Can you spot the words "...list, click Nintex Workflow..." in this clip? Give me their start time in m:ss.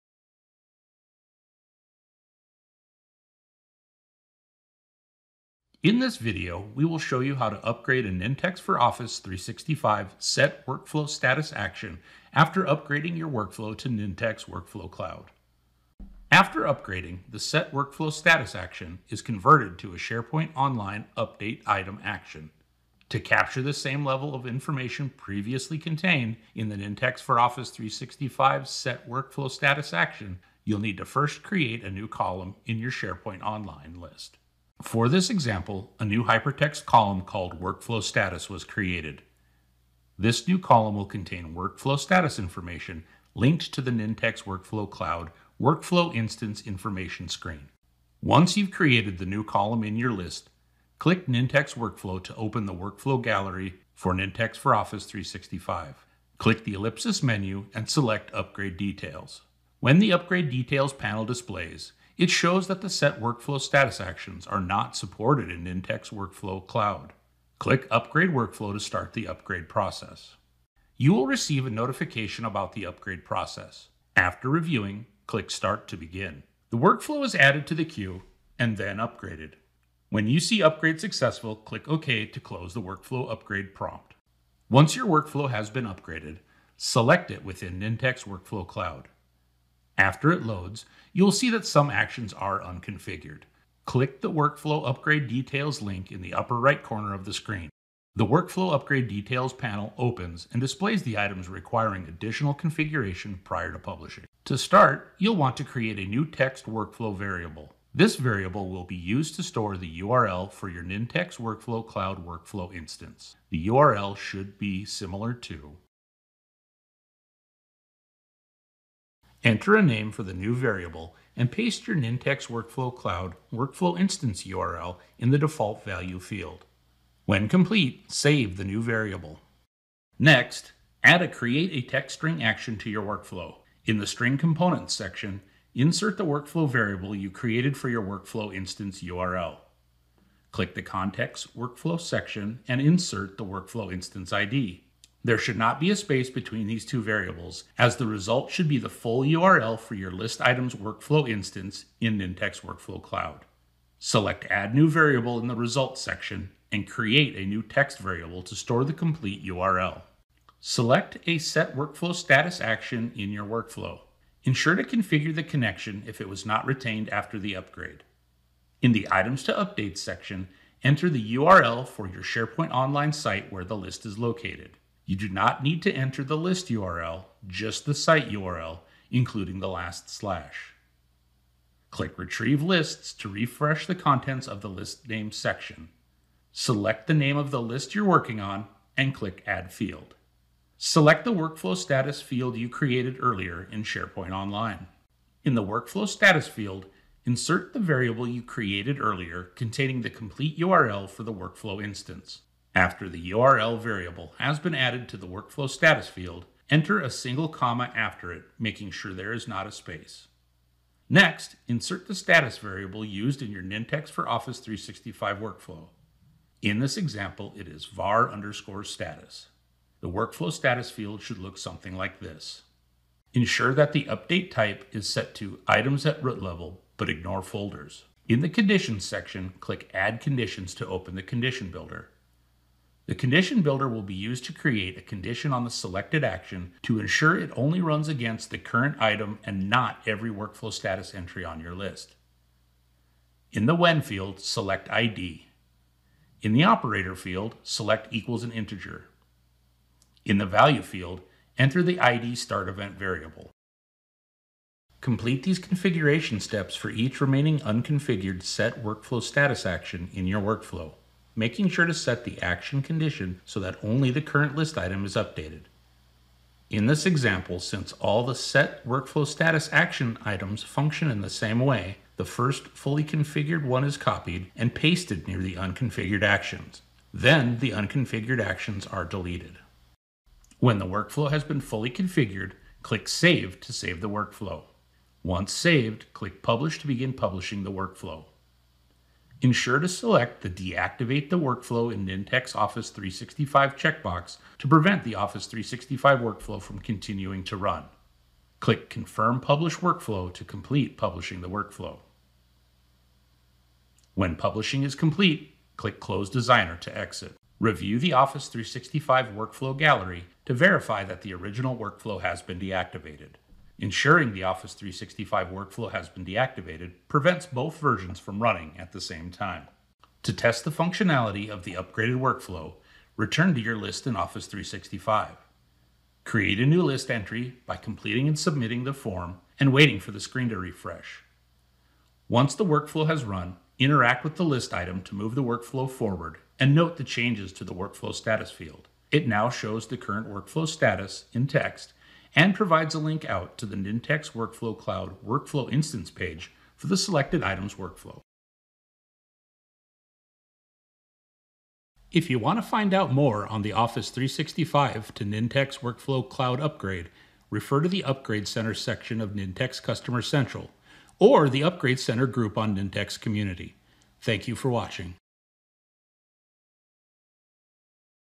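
0:50.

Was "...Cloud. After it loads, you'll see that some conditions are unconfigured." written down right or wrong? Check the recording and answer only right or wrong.
wrong.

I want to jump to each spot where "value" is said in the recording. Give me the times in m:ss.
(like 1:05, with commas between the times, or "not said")
2:05, 4:10.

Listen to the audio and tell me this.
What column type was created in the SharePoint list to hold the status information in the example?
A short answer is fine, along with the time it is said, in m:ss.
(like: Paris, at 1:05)
hypertext, at 0:36.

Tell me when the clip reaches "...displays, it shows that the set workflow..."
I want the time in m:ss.
1:01.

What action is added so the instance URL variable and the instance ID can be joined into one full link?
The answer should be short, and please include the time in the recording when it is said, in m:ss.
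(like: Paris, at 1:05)
Create a Text String, at 2:11.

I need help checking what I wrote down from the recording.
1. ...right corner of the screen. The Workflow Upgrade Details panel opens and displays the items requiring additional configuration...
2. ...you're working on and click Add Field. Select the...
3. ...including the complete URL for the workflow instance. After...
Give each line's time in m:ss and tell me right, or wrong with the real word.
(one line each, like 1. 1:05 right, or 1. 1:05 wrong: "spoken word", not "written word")
1. 1:36 right
2. 3:07 right
3. 3:19 wrong: "containing", not "including".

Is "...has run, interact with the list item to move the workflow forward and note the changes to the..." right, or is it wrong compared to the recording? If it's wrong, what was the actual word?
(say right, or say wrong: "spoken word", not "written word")
right.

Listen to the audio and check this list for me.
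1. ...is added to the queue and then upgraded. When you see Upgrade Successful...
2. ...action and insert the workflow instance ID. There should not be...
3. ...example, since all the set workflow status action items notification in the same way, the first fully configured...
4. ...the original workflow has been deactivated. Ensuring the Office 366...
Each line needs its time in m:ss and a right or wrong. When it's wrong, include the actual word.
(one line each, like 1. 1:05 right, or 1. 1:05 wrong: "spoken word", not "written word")
1. 1:17 right
2. 2:21 wrong: "section", not "action"
3. 4:27 wrong: "function", not "notification"
4. 5:11 wrong: "365", not "366".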